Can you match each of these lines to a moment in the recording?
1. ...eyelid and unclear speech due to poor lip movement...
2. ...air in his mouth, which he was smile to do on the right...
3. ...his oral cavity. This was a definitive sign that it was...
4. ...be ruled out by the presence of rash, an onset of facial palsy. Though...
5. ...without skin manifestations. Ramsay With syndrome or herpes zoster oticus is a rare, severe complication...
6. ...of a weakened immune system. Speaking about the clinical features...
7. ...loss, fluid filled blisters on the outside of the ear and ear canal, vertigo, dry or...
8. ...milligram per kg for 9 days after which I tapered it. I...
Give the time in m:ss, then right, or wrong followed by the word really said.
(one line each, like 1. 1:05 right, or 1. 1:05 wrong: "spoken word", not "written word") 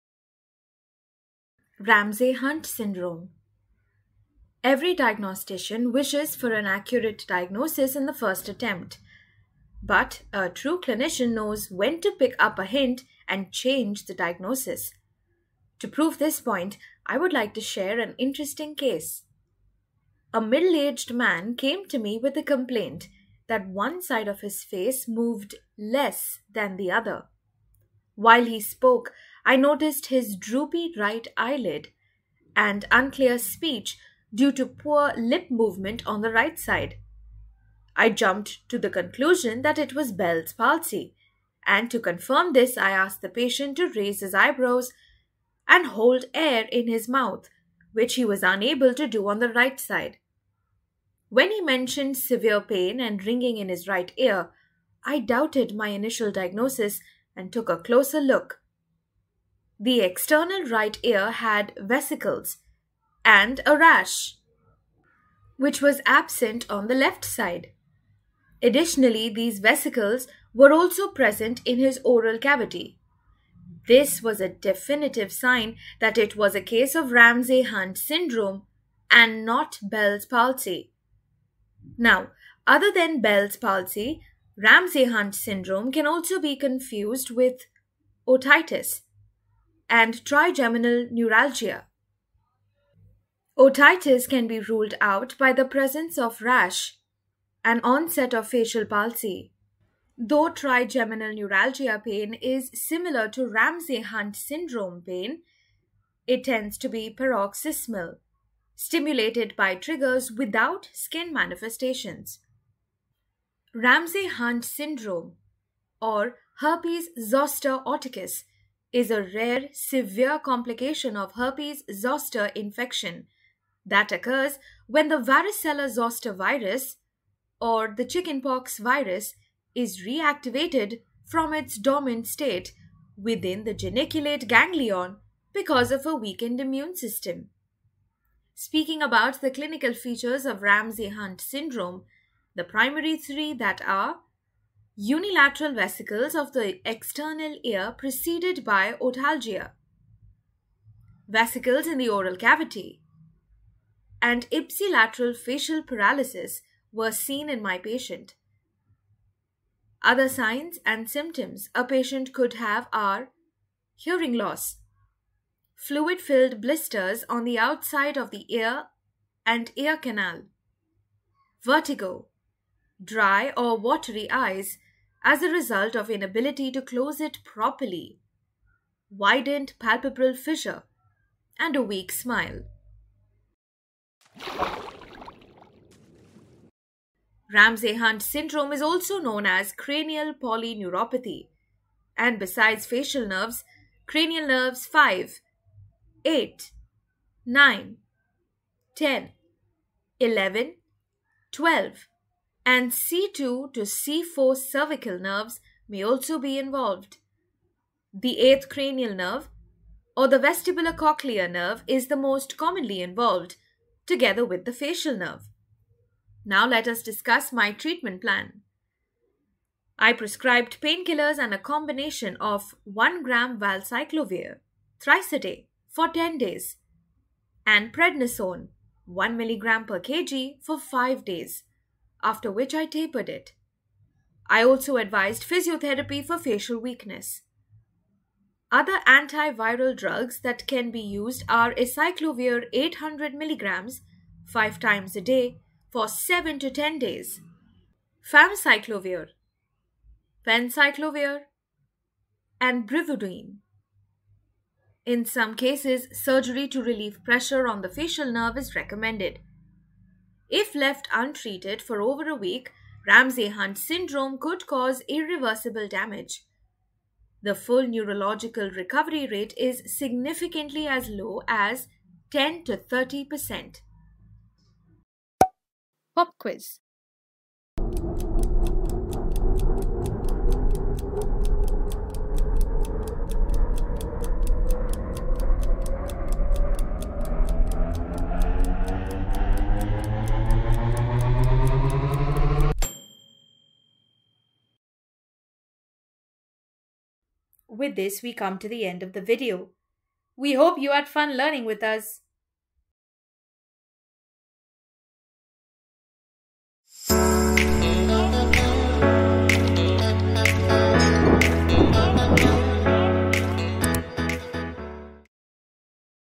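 1. 0:31 right
2. 0:46 wrong: "unable", not "smile"
3. 1:11 right
4. 1:34 right
5. 1:50 wrong: "Hunt", not "With"
6. 2:15 right
7. 2:44 right
8. 3:49 wrong: "5", not "9".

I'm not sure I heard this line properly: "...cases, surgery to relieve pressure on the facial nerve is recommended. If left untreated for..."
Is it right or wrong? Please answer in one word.
right.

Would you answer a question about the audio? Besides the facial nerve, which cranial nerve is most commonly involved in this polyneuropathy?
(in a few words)
8th cranial nerve.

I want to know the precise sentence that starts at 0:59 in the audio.
The external right ear had vesicles and a rash, which was absent on the left side.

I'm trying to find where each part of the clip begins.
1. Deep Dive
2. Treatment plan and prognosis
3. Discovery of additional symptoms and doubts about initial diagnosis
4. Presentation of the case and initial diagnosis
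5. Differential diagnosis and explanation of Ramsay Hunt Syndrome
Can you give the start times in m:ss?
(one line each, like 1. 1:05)
1. 3:04
2. 3:36
3. 0:59
4. 0:20
5. 1:30.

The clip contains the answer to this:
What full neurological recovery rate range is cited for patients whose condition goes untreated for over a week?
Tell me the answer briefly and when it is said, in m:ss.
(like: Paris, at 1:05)
10 to 30%, at 4:32.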